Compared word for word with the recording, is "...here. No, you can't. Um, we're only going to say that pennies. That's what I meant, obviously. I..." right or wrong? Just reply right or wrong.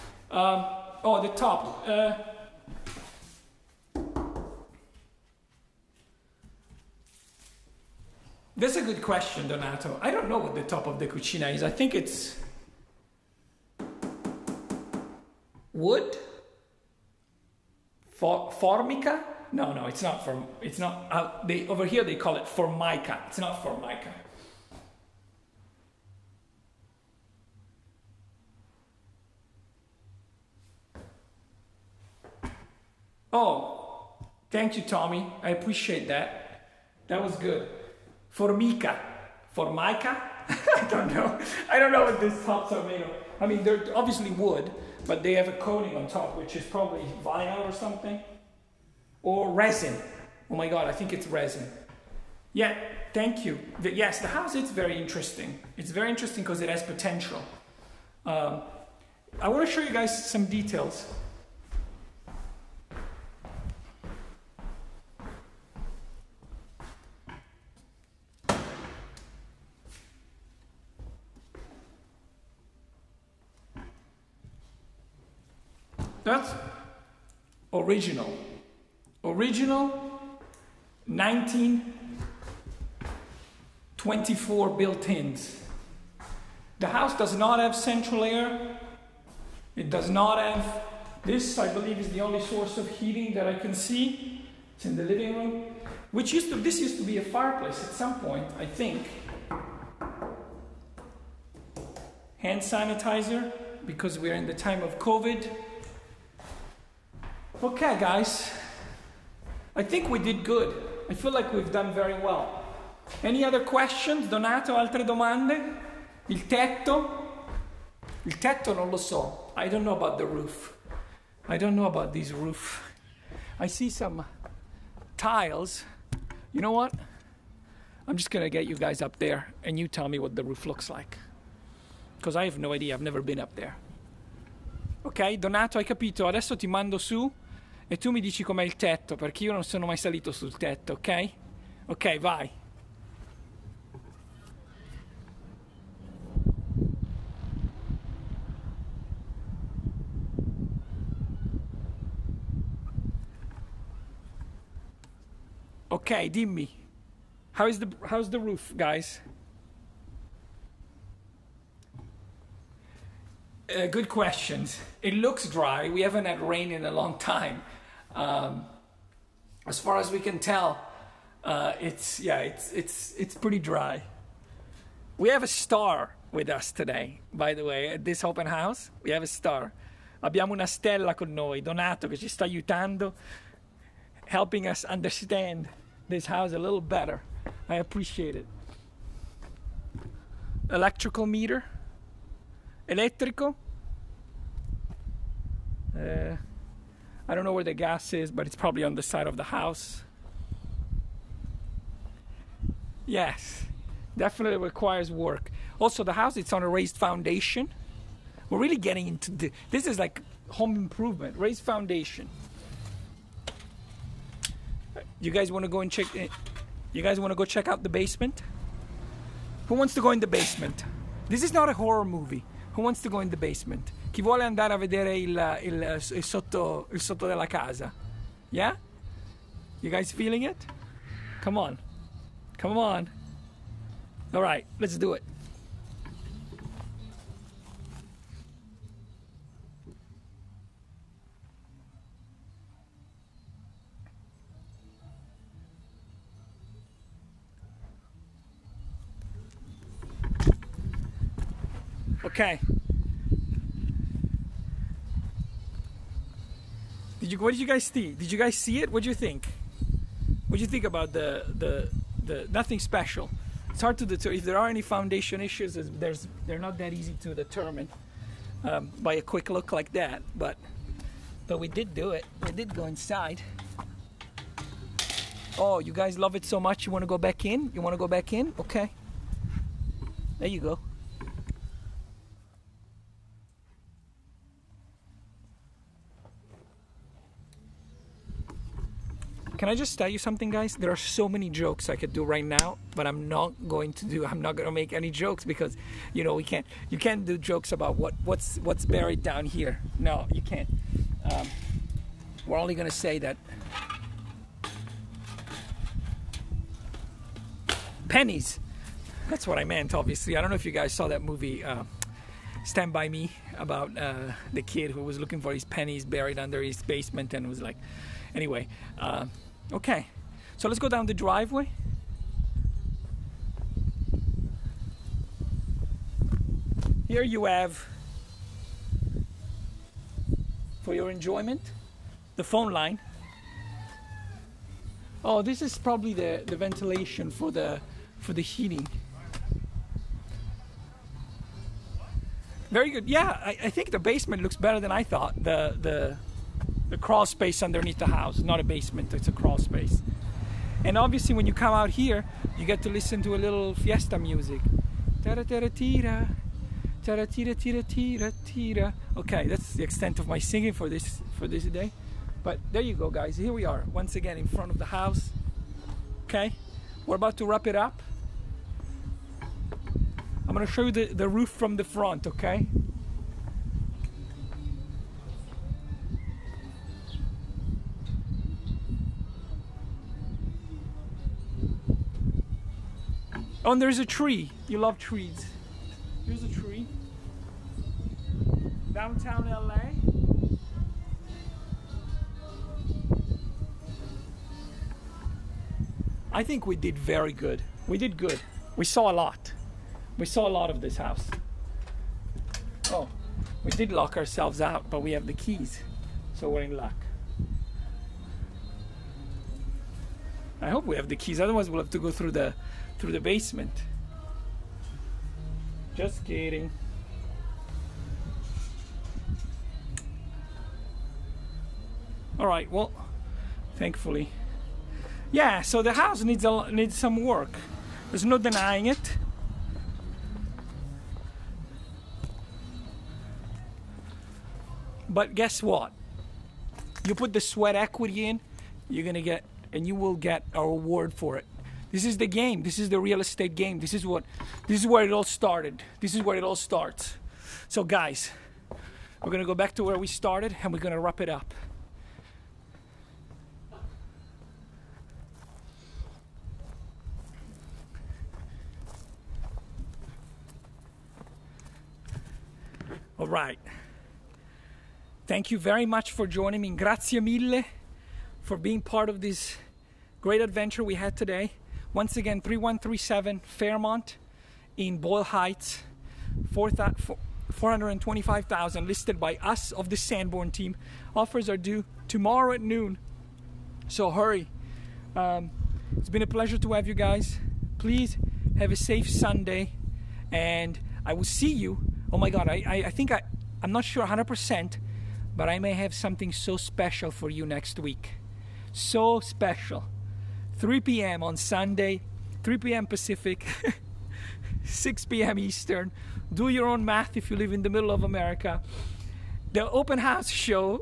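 right.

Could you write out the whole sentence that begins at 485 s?
Um, it's been a pleasure to have you guys.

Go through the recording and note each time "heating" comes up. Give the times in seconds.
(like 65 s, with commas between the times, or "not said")
92 s, 338 s.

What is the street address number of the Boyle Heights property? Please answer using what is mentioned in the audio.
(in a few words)
3137.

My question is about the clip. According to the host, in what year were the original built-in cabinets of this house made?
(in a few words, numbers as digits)
1924.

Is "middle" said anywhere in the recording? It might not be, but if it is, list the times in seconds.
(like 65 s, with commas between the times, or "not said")
507 s.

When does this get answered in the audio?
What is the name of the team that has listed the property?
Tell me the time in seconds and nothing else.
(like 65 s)
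479 s.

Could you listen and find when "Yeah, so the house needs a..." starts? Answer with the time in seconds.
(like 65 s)
425 s.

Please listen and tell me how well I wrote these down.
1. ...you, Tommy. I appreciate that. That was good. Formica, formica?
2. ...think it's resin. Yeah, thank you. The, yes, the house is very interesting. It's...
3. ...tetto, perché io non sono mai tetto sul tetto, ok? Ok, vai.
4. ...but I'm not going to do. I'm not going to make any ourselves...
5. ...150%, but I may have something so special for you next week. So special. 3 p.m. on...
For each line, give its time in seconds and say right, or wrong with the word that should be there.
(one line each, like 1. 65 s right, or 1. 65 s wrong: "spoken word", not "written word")
1. 34 s right
2. 50 s right
3. 138 s wrong: "salito", not "tetto"
4. 292 s wrong: "jokes", not "ourselves"
5. 494 s wrong: "100", not "150".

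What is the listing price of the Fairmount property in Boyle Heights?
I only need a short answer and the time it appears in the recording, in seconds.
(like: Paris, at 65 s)
425,000, at 476 s.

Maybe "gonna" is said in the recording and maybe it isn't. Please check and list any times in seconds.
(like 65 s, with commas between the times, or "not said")
128 s, 370 s, 439 s.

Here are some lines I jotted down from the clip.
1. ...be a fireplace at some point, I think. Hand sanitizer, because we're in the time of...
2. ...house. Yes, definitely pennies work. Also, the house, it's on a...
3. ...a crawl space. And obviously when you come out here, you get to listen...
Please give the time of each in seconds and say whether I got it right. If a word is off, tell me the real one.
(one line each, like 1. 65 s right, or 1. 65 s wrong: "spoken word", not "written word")
1. 97 s right
2. 199 s wrong: "requires", not "pennies"
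3. 349 s right.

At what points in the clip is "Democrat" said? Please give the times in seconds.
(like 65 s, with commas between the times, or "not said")
not said.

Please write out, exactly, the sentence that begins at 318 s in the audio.
Uh Okay, so let's go down the driveway.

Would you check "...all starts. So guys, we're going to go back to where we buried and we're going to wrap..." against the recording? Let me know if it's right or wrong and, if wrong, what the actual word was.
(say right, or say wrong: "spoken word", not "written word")
wrong: "started", not "buried".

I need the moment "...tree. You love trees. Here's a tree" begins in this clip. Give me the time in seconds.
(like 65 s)
384 s.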